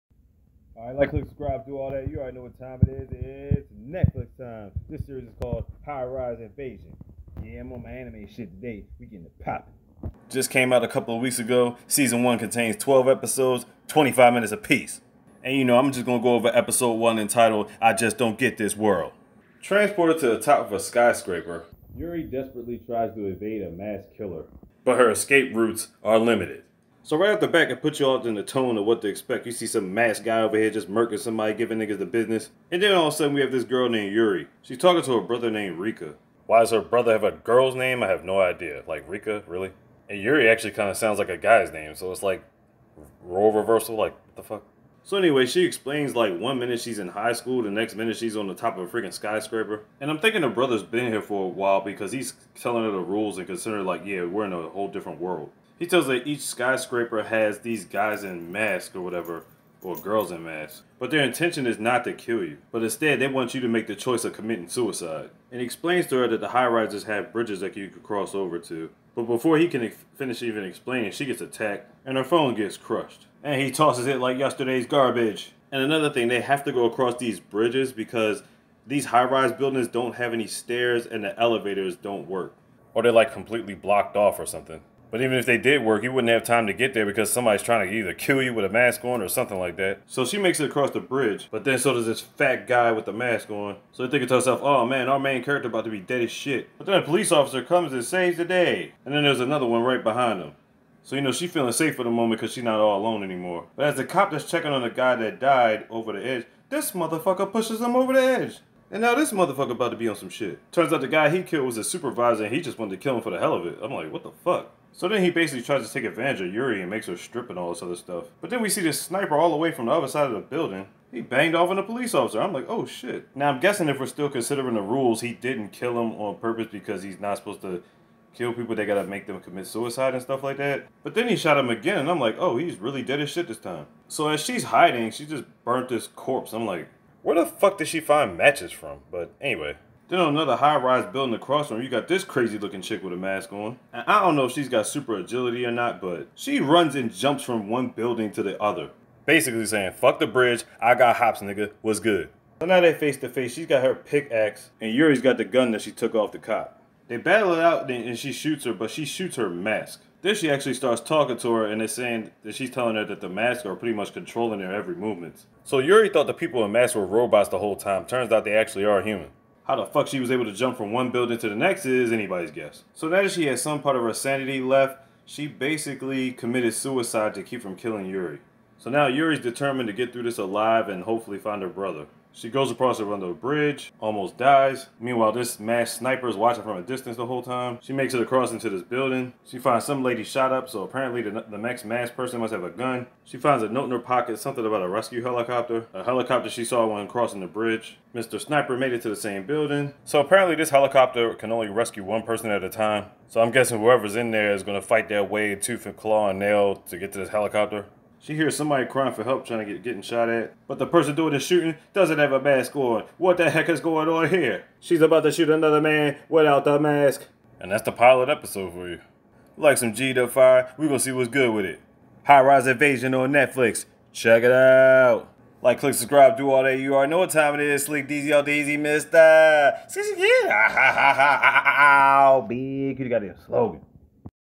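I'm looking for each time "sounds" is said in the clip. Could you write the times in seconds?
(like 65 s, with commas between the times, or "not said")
40 s.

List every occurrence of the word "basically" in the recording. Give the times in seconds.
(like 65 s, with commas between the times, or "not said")
115 s, 149 s, 175 s.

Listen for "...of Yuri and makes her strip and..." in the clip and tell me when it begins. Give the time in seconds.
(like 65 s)
116 s.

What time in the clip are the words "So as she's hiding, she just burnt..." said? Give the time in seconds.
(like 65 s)
134 s.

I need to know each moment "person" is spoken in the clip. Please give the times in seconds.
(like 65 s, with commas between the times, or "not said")
192 s, 202 s, 210 s.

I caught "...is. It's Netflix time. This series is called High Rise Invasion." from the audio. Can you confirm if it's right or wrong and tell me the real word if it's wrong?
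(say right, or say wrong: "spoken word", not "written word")
right.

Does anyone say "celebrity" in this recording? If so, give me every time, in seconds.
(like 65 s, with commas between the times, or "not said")
not said.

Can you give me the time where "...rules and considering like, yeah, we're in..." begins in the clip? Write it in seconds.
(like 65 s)
52 s.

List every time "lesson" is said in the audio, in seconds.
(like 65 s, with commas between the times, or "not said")
not said.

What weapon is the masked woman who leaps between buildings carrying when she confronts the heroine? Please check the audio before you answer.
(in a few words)
Pickaxe.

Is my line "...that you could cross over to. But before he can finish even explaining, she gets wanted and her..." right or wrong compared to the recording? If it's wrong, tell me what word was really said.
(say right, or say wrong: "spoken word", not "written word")
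wrong: "attacked", not "wanted".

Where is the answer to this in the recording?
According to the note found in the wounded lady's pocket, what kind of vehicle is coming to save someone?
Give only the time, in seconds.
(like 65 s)
194 s.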